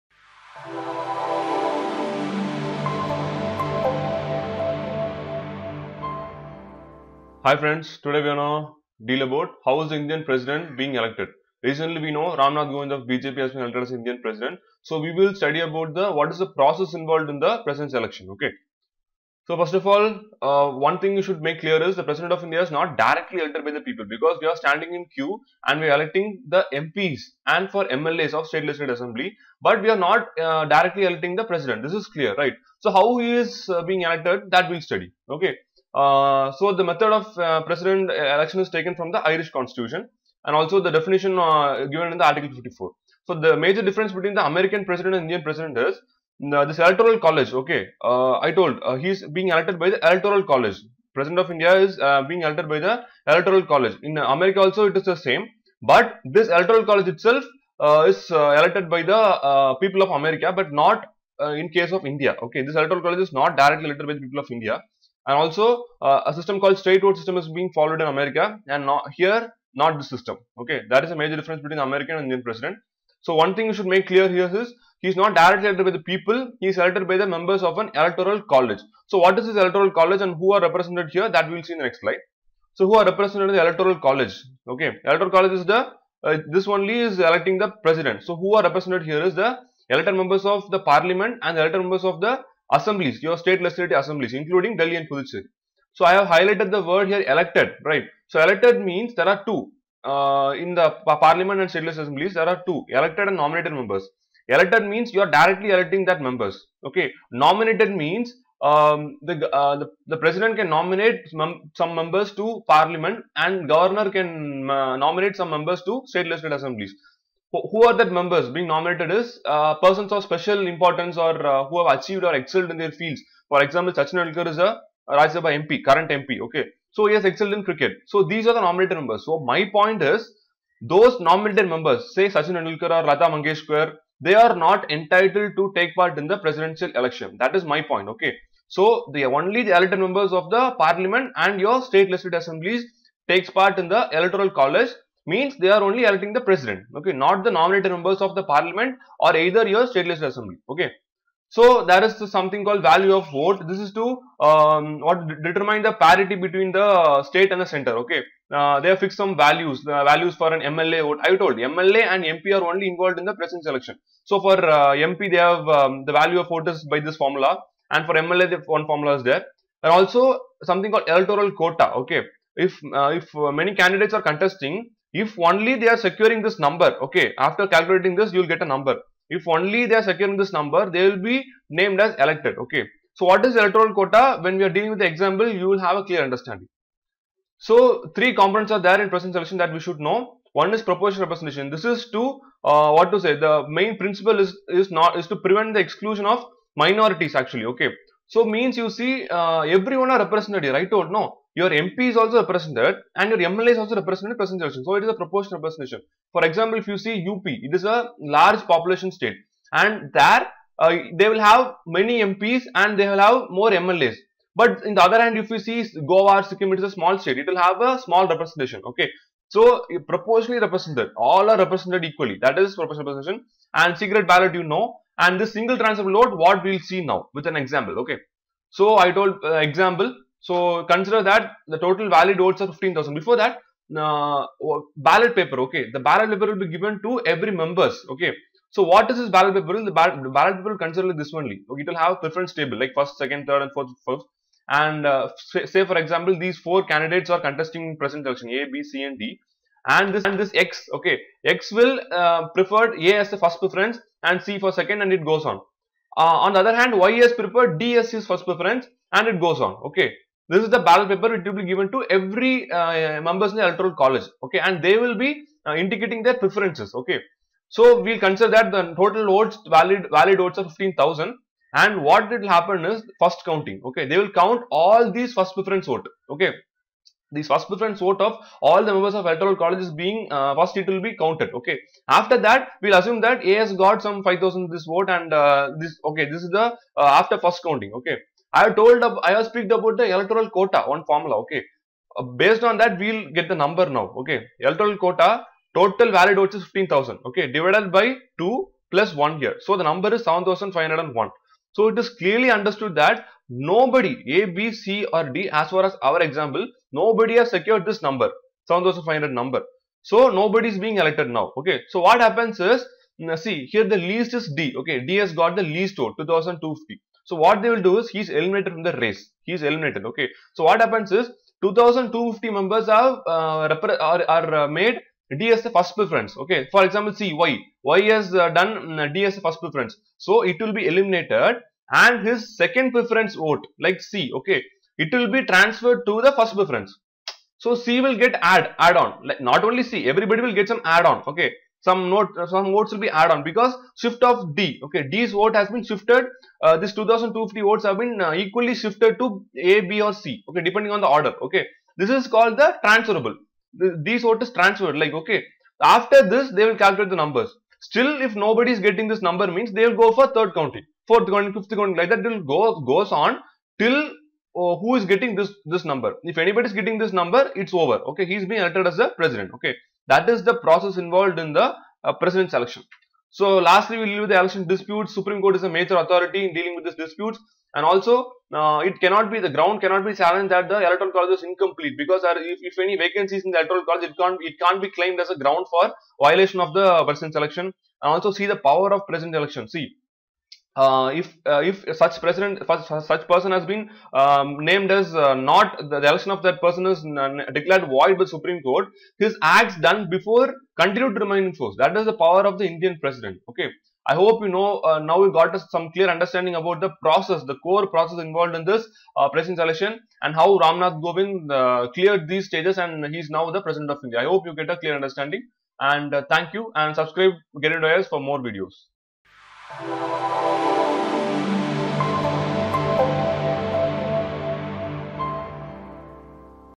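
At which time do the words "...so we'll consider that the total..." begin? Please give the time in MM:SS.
04:27.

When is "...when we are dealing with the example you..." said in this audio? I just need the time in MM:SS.
03:04.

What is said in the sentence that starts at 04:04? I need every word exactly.
And uh, say for example, these four candidates are contesting present election A, B, C, and D.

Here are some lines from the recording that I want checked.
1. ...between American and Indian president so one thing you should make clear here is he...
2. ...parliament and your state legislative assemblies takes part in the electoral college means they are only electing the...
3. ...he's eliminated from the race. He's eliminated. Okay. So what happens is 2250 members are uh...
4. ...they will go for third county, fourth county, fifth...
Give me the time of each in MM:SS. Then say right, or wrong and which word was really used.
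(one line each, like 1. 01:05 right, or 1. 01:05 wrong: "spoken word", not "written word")
1. 01:11 right
2. 02:20 right
3. 05:18 right
4. 05:59 right.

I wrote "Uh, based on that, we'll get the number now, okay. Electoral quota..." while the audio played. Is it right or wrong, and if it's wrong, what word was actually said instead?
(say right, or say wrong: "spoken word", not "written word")
right.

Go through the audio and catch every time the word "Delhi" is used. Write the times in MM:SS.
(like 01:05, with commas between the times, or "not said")
01:34.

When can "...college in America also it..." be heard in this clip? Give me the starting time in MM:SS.
00:53.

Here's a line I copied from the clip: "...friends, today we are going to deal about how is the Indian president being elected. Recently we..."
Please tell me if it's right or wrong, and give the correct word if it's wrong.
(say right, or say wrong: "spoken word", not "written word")
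right.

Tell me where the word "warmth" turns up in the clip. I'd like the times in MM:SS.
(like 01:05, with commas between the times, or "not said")
not said.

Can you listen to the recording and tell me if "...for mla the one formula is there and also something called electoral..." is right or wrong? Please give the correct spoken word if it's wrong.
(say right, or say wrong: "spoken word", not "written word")
right.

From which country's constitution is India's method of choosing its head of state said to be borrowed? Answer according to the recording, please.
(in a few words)
Irish constitution.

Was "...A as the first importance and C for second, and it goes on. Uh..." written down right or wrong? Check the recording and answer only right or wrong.
wrong.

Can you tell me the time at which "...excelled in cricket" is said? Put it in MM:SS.
02:07.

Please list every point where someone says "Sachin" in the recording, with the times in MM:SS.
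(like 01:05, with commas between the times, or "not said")
02:03, 02:12.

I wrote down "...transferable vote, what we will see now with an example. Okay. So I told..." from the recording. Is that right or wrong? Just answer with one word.
right.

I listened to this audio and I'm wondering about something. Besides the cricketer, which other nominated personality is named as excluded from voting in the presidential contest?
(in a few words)
Lata Mangeshkar.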